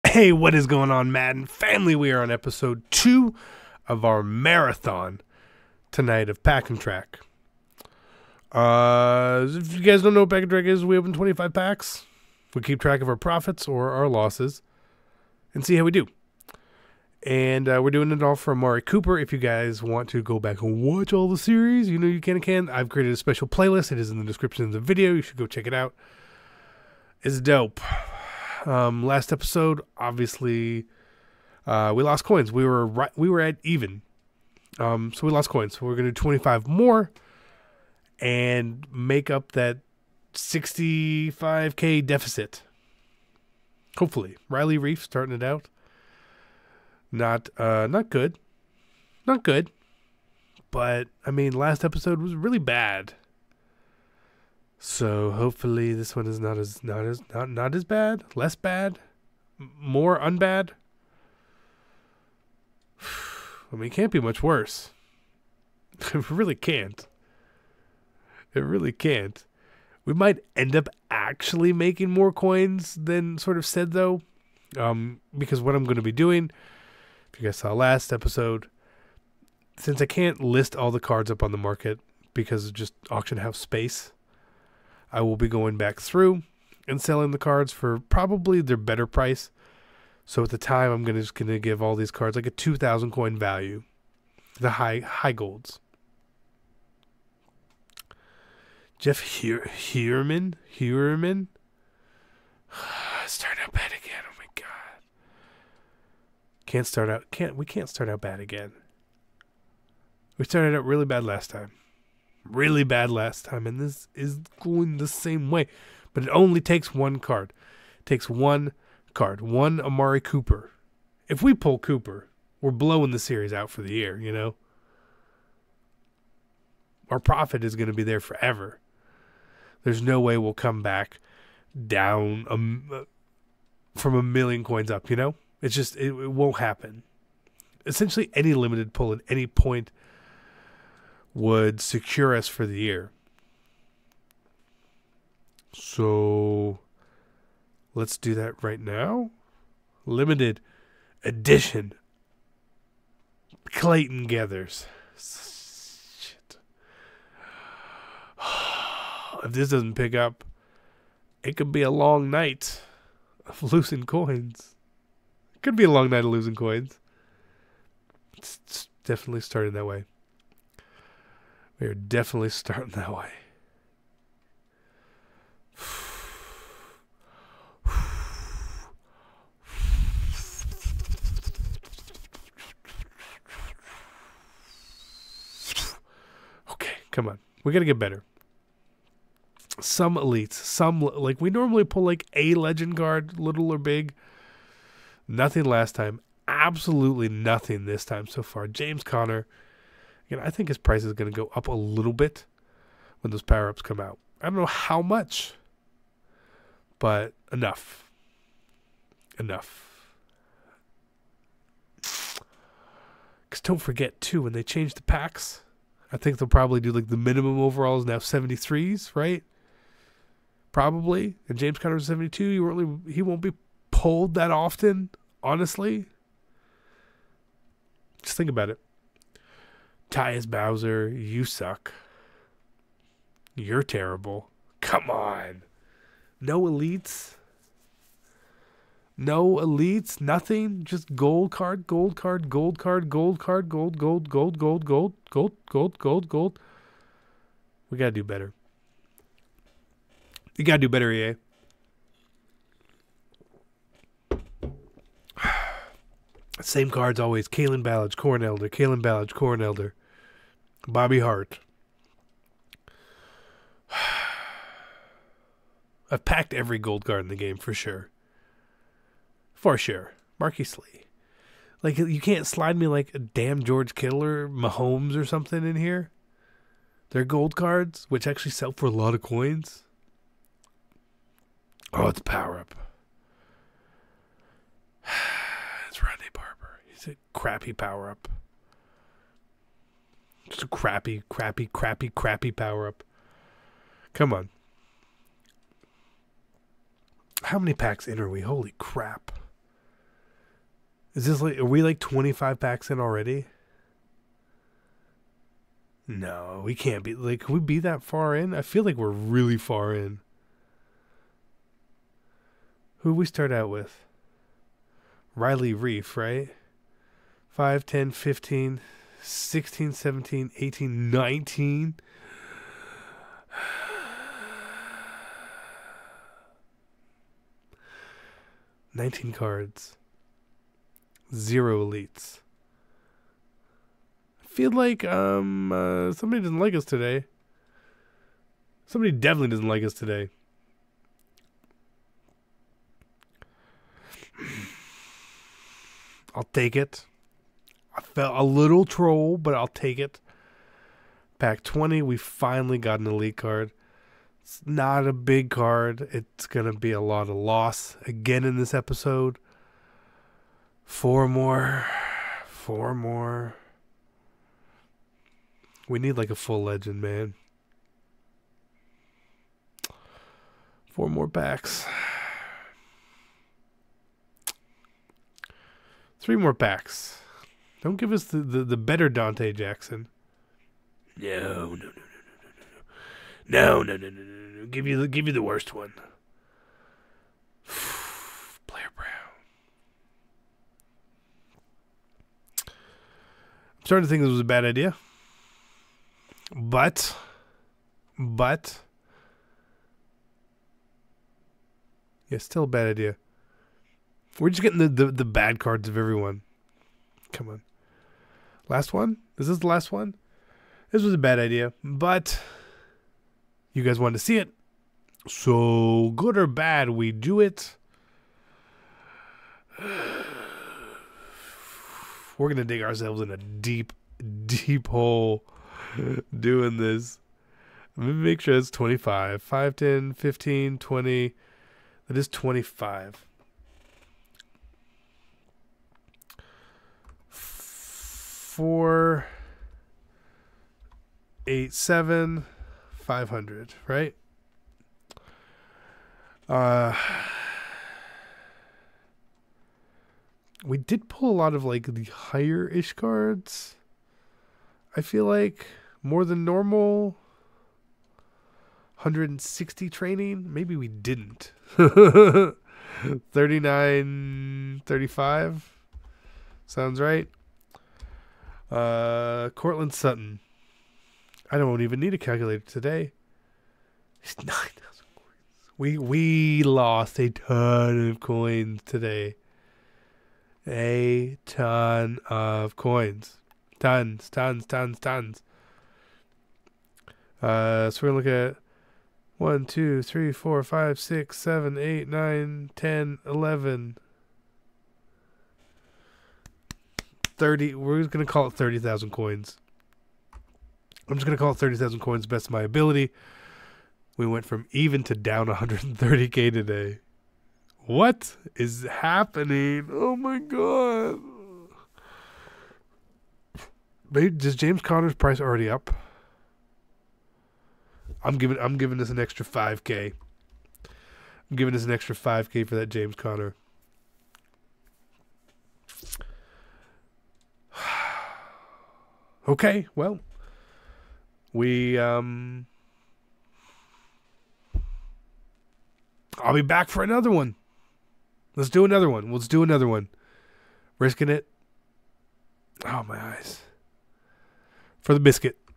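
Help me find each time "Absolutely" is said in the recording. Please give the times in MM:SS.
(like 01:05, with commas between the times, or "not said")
03:16.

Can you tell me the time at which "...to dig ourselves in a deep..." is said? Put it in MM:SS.
07:02.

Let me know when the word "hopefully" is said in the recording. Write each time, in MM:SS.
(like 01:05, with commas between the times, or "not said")
00:43, 00:55.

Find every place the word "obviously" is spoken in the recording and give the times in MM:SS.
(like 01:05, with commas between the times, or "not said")
00:29.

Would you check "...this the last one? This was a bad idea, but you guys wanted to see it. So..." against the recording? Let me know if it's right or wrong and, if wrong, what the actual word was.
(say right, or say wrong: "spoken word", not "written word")
right.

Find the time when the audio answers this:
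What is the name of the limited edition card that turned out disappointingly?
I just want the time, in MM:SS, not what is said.
02:33.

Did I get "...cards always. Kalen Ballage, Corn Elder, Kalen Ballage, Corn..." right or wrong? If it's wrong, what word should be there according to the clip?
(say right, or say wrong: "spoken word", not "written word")
right.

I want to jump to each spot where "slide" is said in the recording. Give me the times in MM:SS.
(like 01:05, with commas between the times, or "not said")
04:32.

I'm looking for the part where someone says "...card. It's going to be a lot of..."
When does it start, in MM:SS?
05:55.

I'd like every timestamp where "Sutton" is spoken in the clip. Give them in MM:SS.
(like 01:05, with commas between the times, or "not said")
07:49.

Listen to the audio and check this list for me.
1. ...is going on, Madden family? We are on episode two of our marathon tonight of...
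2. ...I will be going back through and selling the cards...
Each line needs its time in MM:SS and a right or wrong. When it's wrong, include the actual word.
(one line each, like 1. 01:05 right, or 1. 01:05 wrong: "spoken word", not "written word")
1. 00:00 right
2. 01:25 right.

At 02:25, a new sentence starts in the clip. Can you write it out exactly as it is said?
So let's do that right now.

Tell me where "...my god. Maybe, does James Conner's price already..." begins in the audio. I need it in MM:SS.
08:30.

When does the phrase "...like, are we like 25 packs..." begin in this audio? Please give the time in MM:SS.
05:01.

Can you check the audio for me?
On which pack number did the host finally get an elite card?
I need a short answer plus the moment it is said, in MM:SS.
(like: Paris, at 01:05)
20, at 05:51.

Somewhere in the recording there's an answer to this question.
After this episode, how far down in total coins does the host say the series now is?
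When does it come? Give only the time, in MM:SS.
08:25.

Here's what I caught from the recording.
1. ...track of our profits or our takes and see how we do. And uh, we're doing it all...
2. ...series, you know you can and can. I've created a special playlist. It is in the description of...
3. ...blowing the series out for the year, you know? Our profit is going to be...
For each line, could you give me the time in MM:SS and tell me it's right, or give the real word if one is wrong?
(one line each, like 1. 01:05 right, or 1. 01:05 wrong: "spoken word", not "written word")
1. 00:12 wrong: "losses", not "takes"
2. 00:21 right
3. 02:02 right.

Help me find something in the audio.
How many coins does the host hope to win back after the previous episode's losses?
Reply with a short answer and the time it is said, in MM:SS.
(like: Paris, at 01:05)
65k, at 00:40.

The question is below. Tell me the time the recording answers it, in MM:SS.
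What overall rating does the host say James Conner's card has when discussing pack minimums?
03:42.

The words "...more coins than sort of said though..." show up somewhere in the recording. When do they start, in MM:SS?
01:12.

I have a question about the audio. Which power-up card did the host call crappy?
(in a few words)
Rodney Barber.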